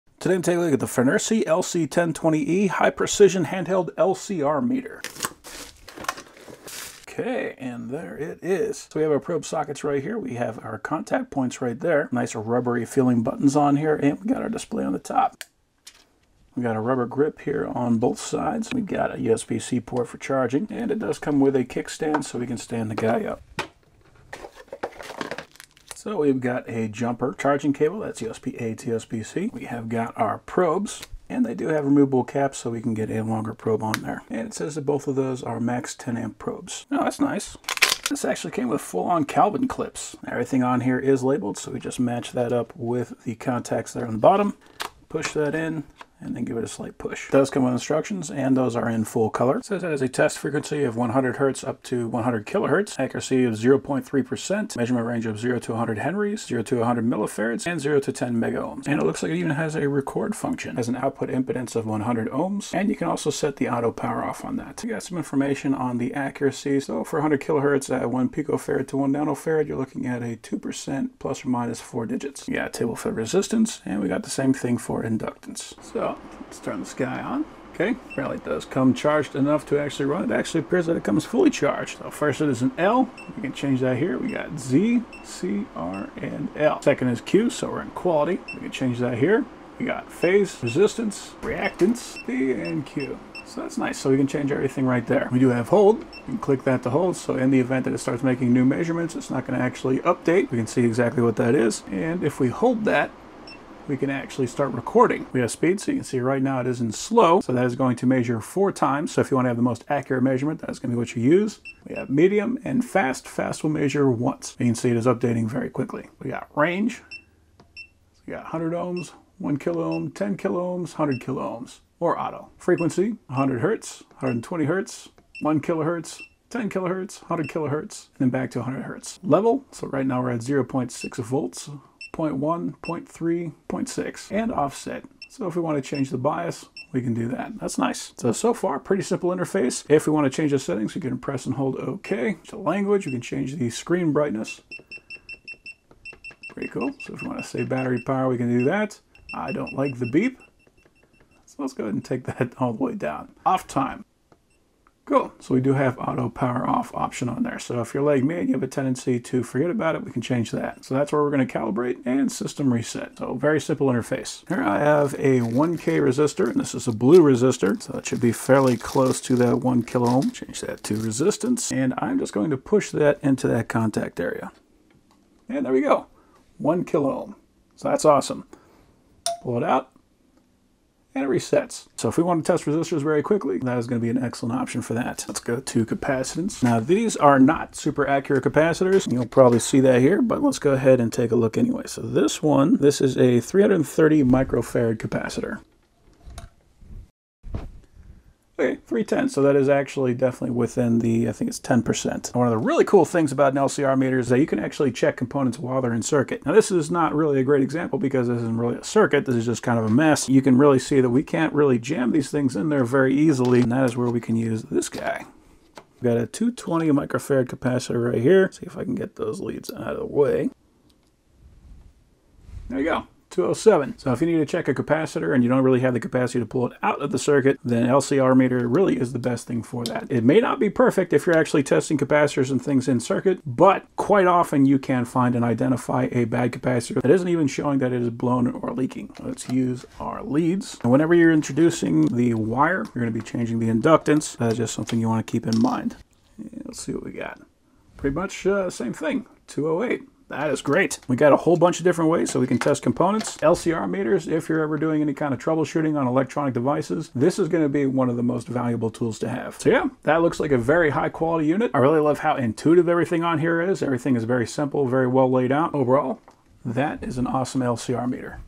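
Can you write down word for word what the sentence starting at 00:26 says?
So we've got a jumper charging cable, that's USB-A to USB-C.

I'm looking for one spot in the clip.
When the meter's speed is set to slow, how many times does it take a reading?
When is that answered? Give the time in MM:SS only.
01:48.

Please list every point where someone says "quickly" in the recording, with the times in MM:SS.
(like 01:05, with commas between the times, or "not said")
01:55, 03:03.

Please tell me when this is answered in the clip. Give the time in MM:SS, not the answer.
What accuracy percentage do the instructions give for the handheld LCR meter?
00:52.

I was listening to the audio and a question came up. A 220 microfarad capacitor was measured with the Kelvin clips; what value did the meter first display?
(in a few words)
207.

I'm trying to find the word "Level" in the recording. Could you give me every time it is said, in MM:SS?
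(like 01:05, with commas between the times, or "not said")
02:09.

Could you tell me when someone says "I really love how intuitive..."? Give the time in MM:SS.
04:21.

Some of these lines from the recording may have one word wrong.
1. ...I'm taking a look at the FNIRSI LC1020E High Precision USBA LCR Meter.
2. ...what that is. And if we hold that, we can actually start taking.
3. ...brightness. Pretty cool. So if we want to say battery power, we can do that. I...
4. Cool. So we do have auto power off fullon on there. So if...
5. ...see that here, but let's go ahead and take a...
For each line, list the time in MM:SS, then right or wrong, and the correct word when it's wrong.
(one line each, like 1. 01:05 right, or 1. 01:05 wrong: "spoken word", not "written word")
1. 00:00 wrong: "Handheld", not "USBA"
2. 01:41 wrong: "recording", not "taking"
3. 02:24 right
4. 02:35 wrong: "option", not "fullon"
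5. 03:09 right.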